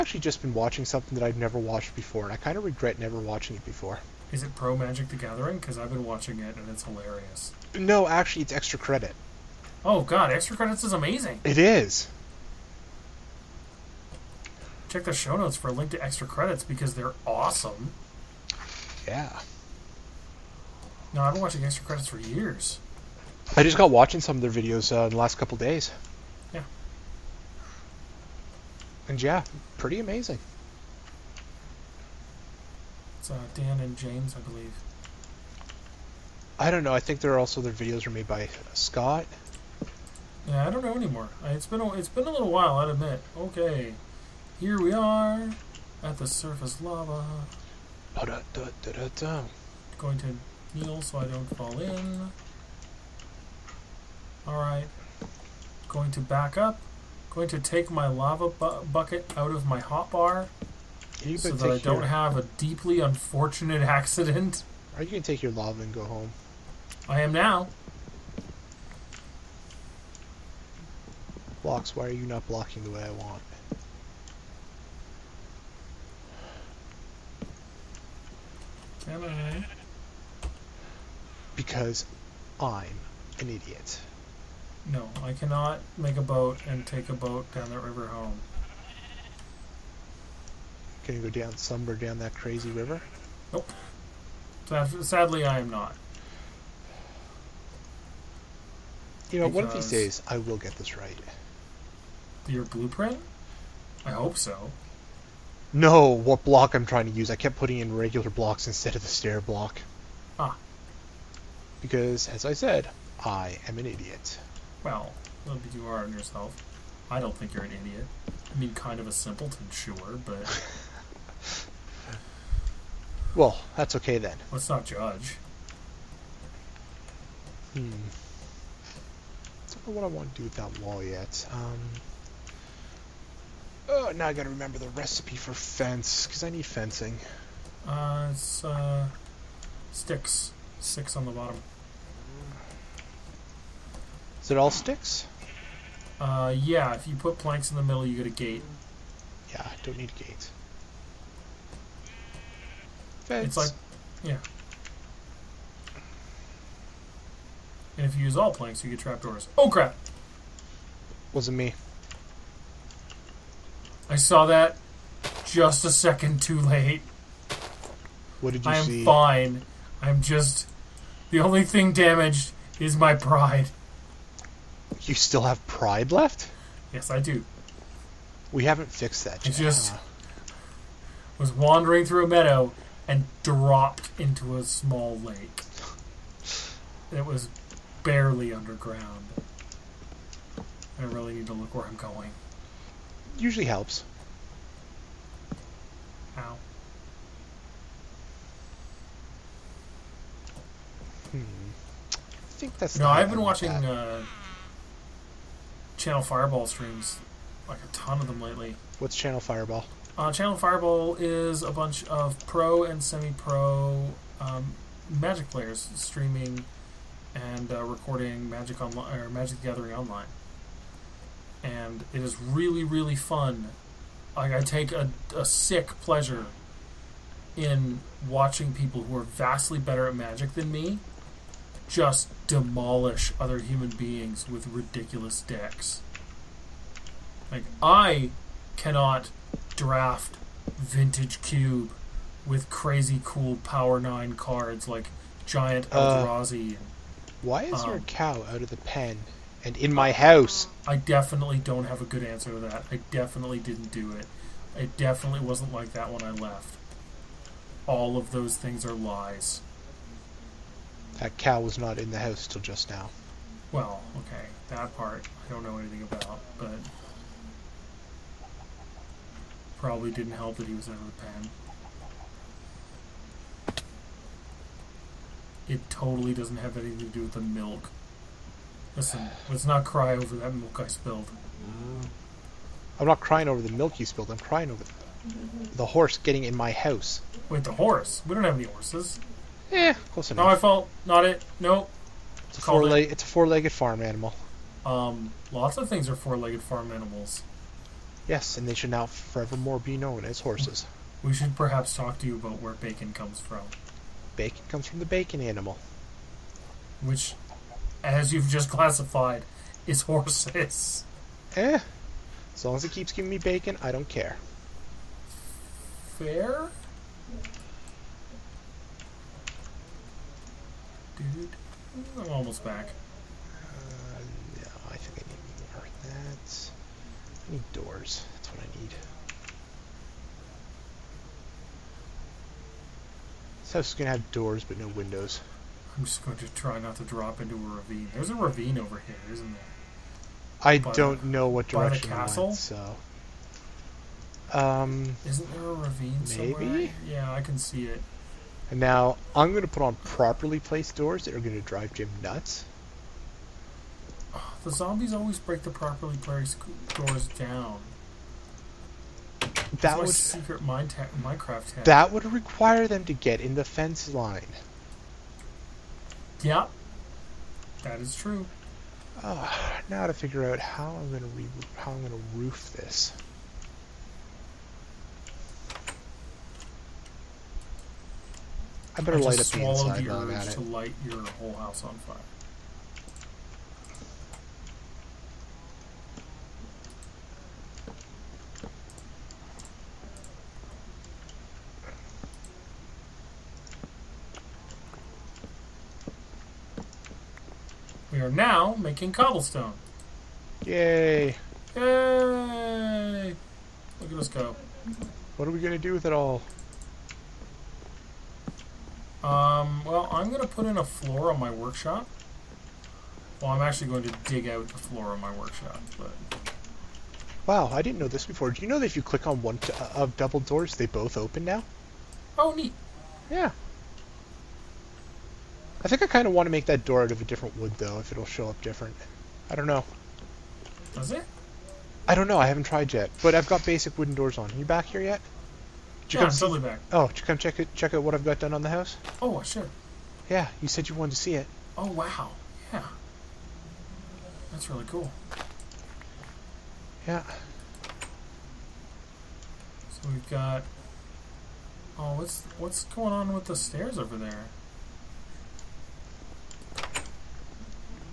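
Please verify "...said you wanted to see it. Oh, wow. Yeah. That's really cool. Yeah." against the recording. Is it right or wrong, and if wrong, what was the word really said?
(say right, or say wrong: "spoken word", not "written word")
right.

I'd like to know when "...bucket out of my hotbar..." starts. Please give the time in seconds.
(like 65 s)
58 s.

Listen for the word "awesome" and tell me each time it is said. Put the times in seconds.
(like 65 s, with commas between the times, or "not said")
17 s.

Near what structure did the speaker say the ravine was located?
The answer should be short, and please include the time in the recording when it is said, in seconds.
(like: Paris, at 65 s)
The castle, at 342 s.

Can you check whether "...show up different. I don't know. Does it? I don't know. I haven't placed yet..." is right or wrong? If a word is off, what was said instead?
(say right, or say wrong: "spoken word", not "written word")
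wrong: "tried", not "placed".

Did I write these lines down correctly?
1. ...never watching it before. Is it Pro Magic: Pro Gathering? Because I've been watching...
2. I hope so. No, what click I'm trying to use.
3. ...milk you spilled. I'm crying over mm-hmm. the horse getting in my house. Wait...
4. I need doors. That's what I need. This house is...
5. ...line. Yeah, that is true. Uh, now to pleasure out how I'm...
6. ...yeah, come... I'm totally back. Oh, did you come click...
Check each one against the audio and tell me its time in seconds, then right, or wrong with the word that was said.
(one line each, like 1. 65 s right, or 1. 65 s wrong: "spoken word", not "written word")
1. 2 s wrong: "The", not "Pro"
2. 104 s wrong: "block", not "click"
3. 283 s right
4. 327 s right
5. 364 s wrong: "figure", not "pleasure"
6. 436 s wrong: "check", not "click".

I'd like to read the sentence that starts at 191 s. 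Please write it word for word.
I really need to look where I'm going.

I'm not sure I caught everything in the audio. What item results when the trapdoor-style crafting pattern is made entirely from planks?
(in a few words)
Trapdoors.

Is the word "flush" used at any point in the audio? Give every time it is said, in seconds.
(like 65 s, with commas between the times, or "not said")
not said.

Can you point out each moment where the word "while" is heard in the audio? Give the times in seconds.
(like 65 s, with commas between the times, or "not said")
42 s, 380 s.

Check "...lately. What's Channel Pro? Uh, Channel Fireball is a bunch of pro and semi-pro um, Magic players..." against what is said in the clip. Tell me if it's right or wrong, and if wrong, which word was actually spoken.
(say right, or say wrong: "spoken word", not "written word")
wrong: "Fireball", not "Pro".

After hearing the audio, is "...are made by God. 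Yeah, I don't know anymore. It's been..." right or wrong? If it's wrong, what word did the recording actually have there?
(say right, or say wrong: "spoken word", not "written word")
wrong: "Scott", not "God".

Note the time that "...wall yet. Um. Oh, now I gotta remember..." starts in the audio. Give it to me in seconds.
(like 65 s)
130 s.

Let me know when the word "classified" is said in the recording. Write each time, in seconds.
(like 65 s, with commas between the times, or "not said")
308 s.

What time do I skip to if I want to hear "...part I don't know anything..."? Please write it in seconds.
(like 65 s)
264 s.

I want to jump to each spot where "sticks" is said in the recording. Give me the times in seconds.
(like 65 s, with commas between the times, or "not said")
139 s, 144 s.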